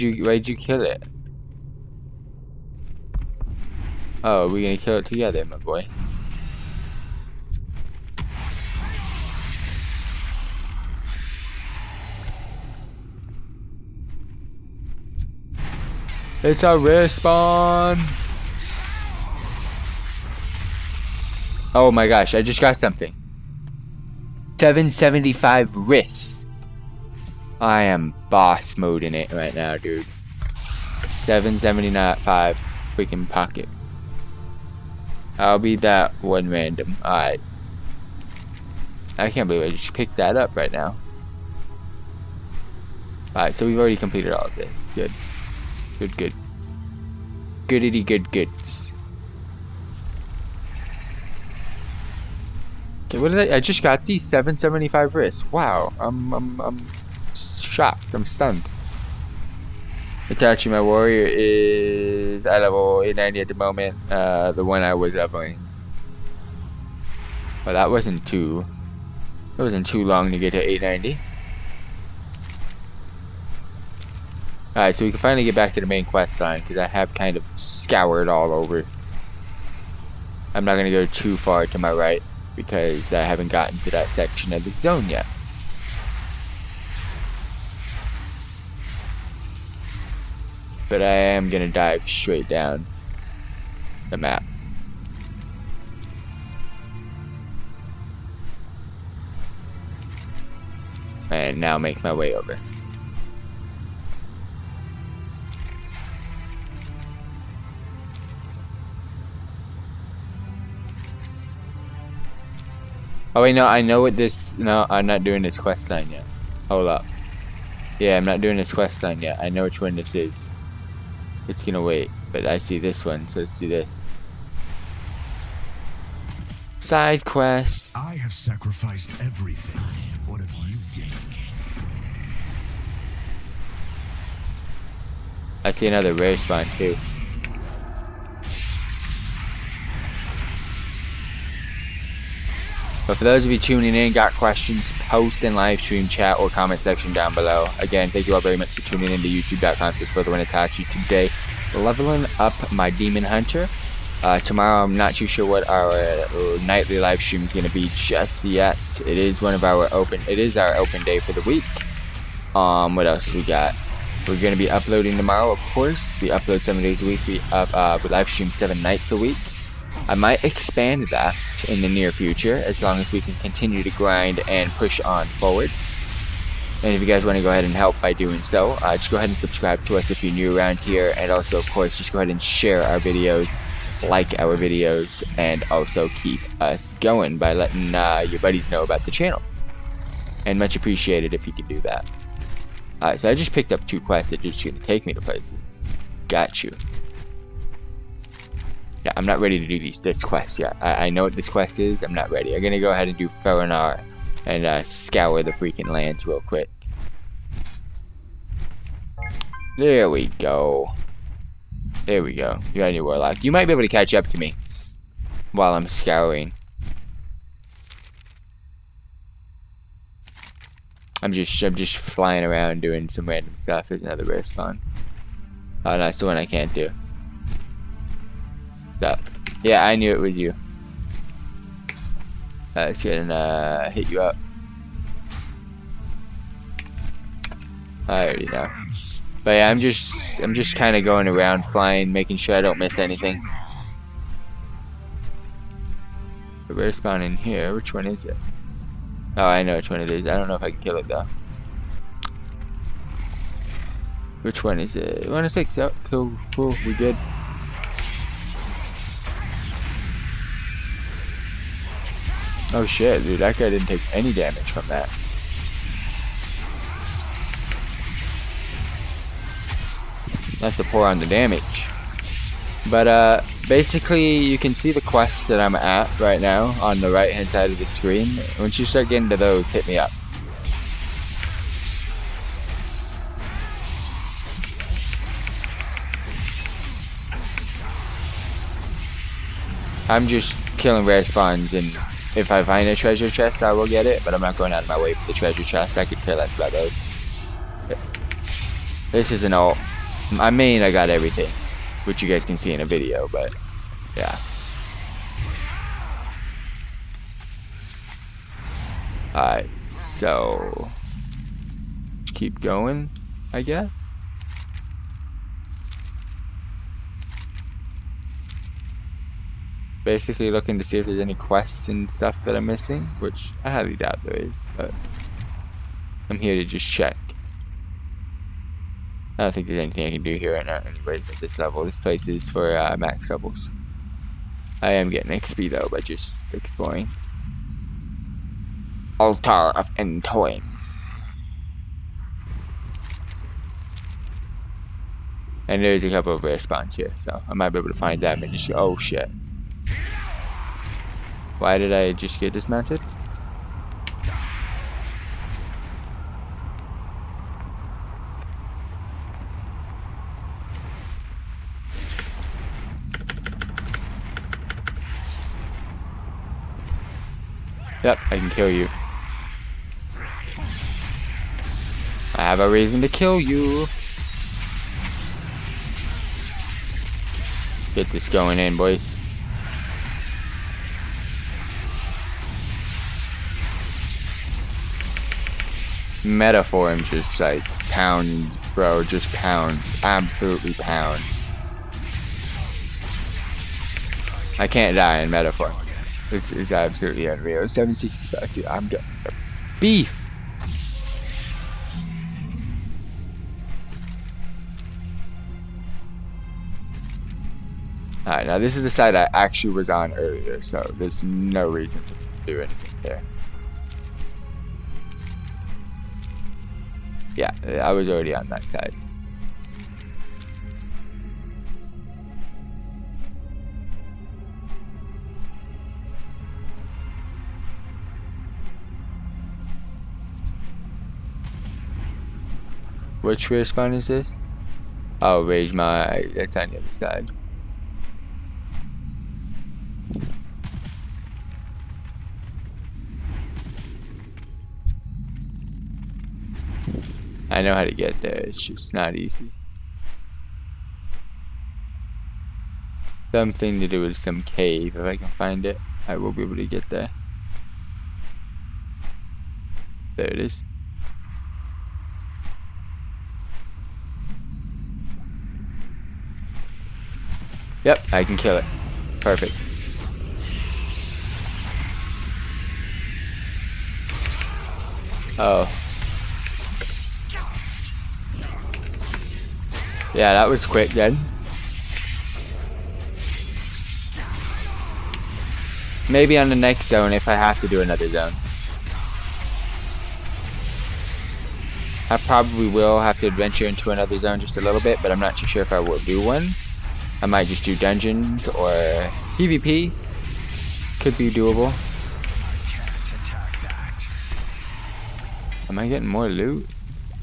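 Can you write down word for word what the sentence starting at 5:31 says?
This place is for uh, max levels.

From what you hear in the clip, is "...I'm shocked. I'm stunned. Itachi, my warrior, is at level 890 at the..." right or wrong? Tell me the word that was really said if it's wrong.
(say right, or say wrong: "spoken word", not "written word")
right.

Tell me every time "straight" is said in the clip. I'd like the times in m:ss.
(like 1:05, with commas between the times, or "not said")
1:32.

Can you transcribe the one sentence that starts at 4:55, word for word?
I could care less about those.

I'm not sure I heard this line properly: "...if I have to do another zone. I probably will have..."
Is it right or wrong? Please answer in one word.
right.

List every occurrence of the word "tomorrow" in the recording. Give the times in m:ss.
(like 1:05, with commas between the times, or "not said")
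2:34, 2:45.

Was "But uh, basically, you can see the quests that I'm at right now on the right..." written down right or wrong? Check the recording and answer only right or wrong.
right.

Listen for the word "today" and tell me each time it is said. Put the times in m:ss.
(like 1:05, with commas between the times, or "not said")
2:30.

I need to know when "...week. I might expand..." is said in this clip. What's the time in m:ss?
2:49.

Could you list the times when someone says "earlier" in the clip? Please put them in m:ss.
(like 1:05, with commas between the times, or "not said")
6:50.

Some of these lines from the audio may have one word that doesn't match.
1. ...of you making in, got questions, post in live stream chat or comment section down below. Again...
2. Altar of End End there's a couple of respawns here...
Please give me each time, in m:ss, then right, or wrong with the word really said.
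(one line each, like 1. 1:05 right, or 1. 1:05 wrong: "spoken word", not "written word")
1. 2:23 wrong: "tuning", not "making"
2. 5:39 wrong: "And", not "End".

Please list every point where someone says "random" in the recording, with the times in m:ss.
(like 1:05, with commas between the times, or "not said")
0:36, 3:43.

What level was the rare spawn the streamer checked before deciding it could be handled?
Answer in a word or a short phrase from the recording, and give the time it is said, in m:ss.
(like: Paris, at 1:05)
106, at 4:15.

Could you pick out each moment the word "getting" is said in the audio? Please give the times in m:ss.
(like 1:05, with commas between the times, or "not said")
4:39, 5:35, 8:25.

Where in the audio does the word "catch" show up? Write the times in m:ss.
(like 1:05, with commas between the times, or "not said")
3:33.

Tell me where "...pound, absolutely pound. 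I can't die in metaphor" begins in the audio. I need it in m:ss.
6:29.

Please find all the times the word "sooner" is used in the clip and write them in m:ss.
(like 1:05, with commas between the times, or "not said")
not said.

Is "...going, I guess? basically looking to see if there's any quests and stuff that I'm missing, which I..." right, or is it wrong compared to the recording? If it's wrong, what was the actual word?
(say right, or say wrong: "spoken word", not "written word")
right.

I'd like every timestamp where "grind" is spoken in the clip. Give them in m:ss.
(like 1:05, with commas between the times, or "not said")
2:53.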